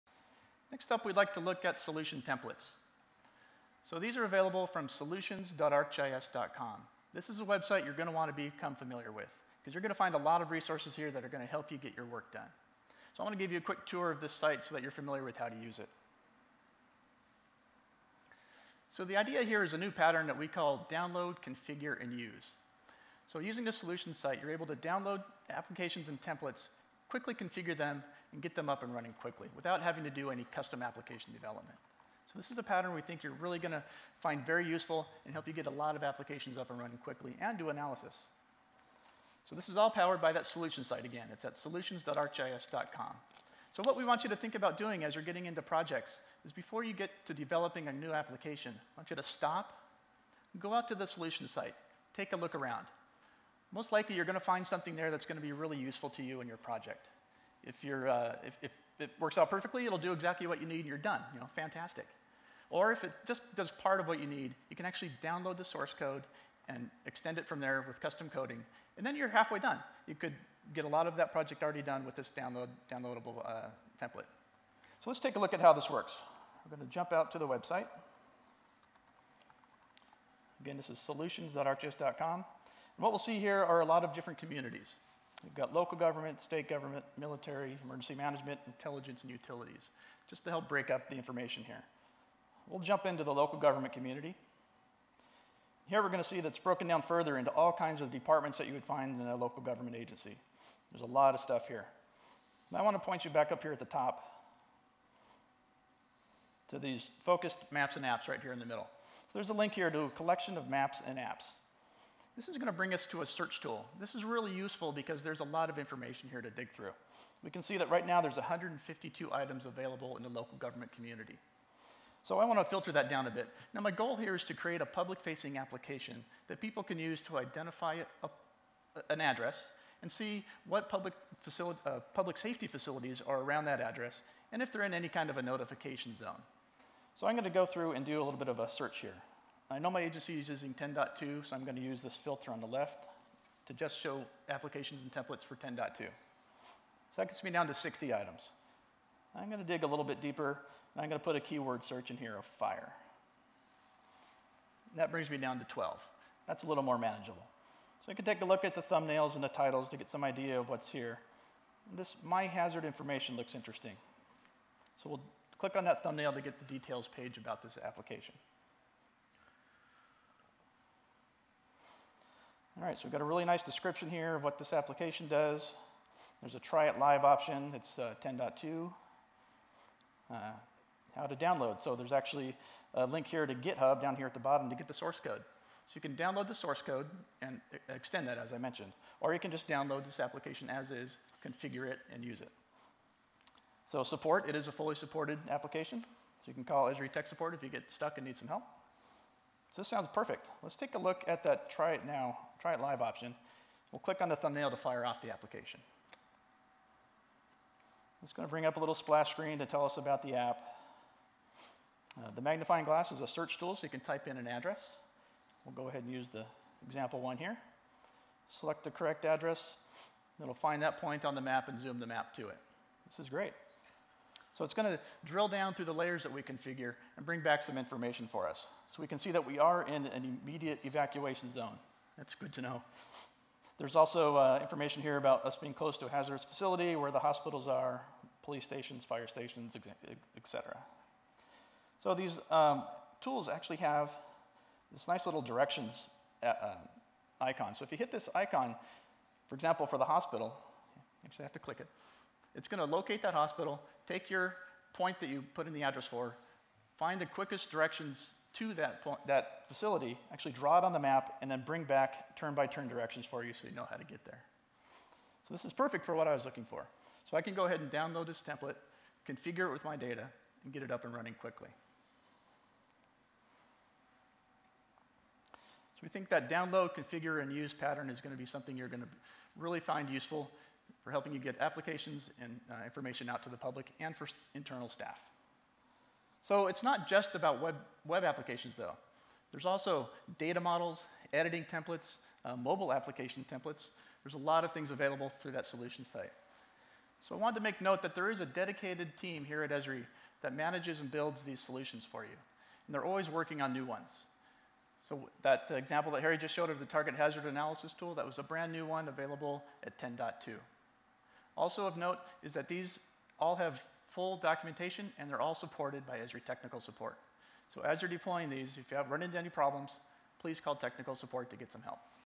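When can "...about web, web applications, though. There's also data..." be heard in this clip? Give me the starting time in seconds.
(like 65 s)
287 s.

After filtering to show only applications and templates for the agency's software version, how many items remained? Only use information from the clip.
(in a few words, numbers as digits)
60.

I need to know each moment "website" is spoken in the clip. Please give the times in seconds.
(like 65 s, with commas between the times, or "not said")
7 s, 77 s.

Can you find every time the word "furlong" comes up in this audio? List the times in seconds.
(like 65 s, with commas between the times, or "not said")
not said.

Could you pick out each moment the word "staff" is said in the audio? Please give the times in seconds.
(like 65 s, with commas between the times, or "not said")
284 s.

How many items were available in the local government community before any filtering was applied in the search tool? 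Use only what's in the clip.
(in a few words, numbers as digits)
152.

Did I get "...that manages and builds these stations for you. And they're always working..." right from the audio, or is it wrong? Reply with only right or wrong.
wrong.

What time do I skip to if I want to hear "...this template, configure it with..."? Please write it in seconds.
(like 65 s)
268 s.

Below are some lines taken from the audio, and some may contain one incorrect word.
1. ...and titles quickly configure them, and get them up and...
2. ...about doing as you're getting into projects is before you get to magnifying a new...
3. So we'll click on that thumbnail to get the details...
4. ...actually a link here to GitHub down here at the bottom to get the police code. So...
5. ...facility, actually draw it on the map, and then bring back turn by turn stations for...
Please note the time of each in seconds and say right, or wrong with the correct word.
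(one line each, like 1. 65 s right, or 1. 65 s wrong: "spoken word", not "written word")
1. 26 s wrong: "templates", not "titles"
2. 44 s wrong: "developing", not "magnifying"
3. 165 s right
4. 182 s wrong: "source", not "police"
5. 259 s wrong: "directions", not "stations".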